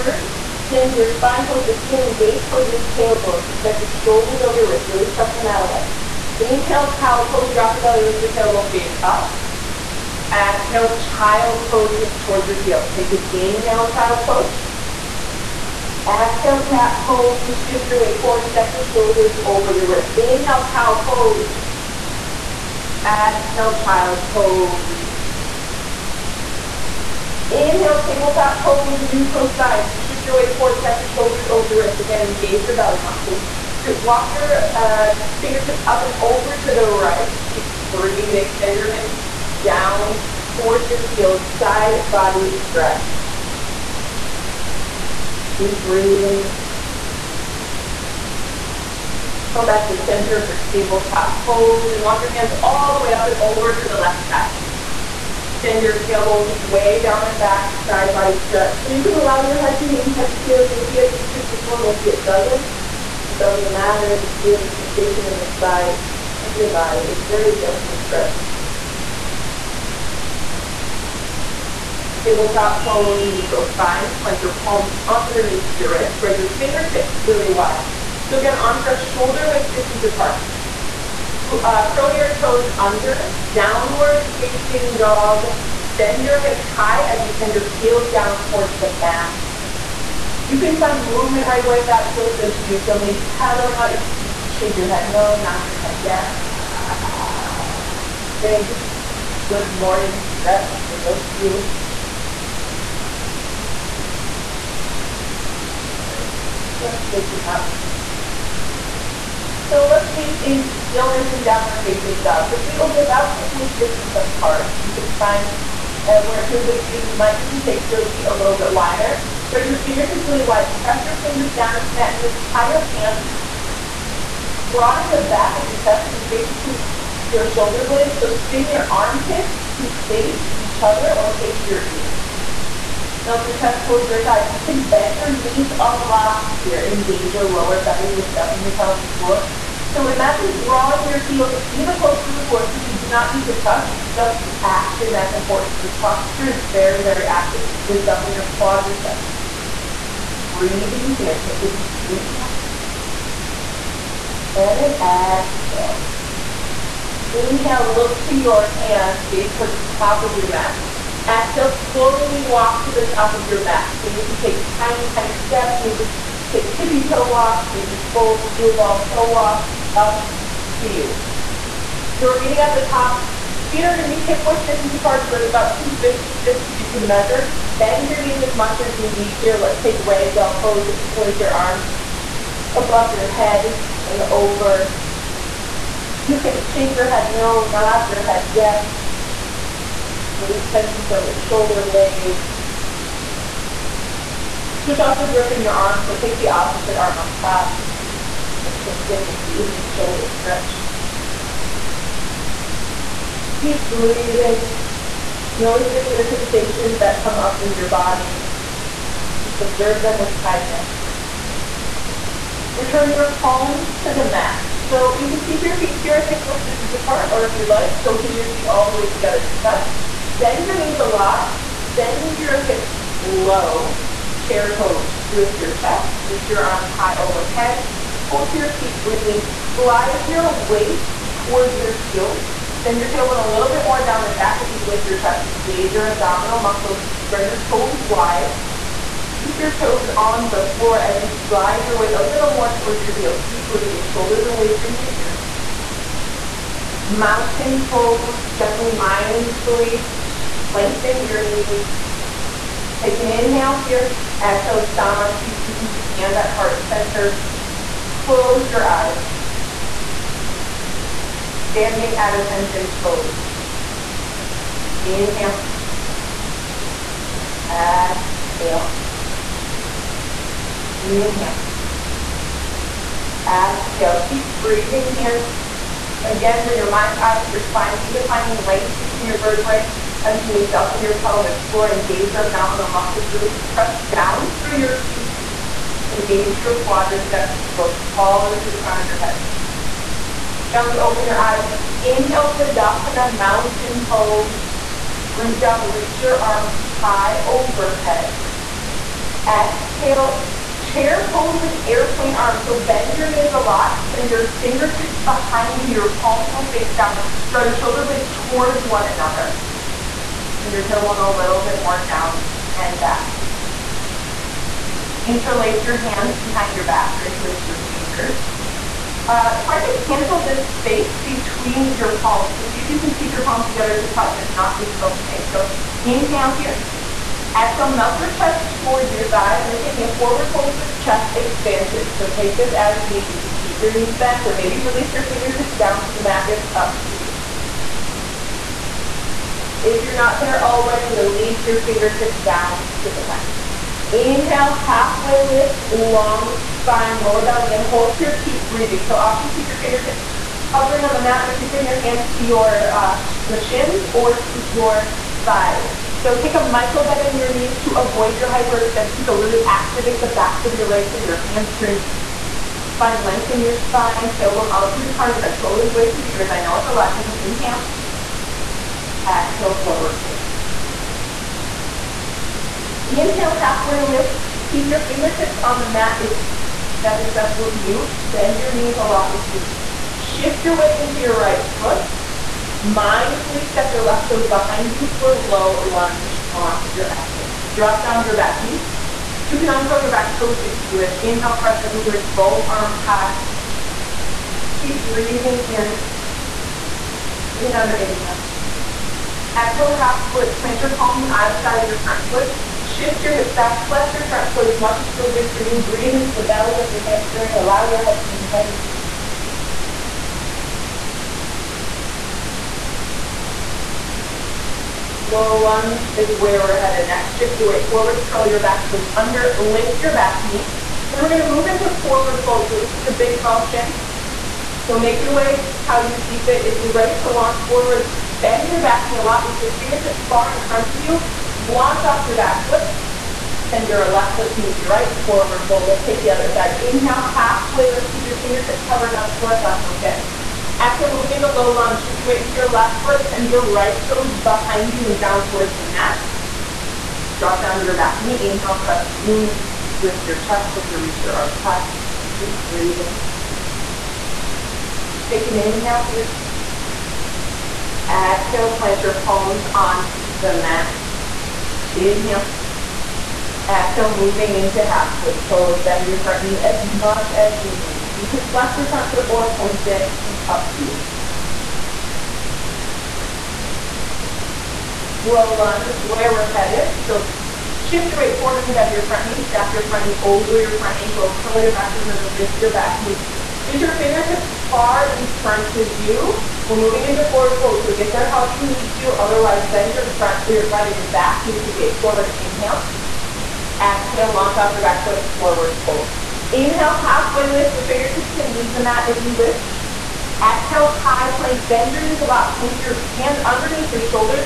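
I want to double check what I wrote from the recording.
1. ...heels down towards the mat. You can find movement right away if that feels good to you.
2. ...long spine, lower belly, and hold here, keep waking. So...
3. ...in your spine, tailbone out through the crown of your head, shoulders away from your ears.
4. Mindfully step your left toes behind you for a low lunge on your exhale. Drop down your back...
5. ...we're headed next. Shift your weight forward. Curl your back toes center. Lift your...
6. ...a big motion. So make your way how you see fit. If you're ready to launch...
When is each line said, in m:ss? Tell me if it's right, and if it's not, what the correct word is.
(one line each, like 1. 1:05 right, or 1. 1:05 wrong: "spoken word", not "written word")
1. 1:27 right
2. 5:45 wrong: "breathing", not "waking"
3. 6:03 right
4. 6:22 right
5. 6:56 wrong: "under", not "center"
6. 7:03 right.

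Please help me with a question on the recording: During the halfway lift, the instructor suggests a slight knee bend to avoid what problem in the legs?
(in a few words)
hyperextension.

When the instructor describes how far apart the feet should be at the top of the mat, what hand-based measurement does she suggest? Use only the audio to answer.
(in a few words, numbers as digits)
two fist width.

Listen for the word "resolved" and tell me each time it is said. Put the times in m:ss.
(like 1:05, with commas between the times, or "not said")
not said.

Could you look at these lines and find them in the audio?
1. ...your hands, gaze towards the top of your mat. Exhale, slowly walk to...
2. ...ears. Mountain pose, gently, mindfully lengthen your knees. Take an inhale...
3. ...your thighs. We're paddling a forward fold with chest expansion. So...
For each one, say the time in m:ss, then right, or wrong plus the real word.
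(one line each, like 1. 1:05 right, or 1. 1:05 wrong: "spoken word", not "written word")
1. 2:38 right
2. 4:05 right
3. 5:29 wrong: "taking", not "paddling".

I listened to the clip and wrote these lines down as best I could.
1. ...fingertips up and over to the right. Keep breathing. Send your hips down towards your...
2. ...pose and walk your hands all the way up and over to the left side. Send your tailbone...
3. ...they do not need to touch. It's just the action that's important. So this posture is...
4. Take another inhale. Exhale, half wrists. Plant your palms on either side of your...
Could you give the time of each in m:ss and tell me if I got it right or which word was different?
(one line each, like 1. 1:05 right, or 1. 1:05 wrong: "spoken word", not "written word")
1. 0:35 right
2. 0:51 right
3. 2:22 right
4. 6:37 wrong: "splits", not "wrists".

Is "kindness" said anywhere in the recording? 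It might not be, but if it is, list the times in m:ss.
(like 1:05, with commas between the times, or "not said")
3:30.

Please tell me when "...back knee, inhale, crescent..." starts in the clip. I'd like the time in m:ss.
7:27.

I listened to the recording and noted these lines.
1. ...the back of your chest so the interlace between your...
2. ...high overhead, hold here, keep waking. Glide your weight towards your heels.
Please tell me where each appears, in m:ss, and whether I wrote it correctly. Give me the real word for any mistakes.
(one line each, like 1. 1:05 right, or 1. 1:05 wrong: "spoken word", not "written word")
1. 2:05 wrong: "space", not "interlace"
2. 3:46 wrong: "breathing", not "waking".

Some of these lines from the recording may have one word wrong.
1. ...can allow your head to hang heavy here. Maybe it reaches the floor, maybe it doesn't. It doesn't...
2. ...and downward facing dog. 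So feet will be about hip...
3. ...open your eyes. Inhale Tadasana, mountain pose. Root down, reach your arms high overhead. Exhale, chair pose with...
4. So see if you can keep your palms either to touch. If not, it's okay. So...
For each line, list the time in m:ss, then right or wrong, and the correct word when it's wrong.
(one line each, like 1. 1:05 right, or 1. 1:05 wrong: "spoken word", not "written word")
1. 0:59 right
2. 1:51 right
3. 4:50 right
4. 5:22 wrong: "together", not "either".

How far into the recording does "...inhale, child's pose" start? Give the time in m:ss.
0:13.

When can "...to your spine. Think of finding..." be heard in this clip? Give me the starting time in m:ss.
4:37.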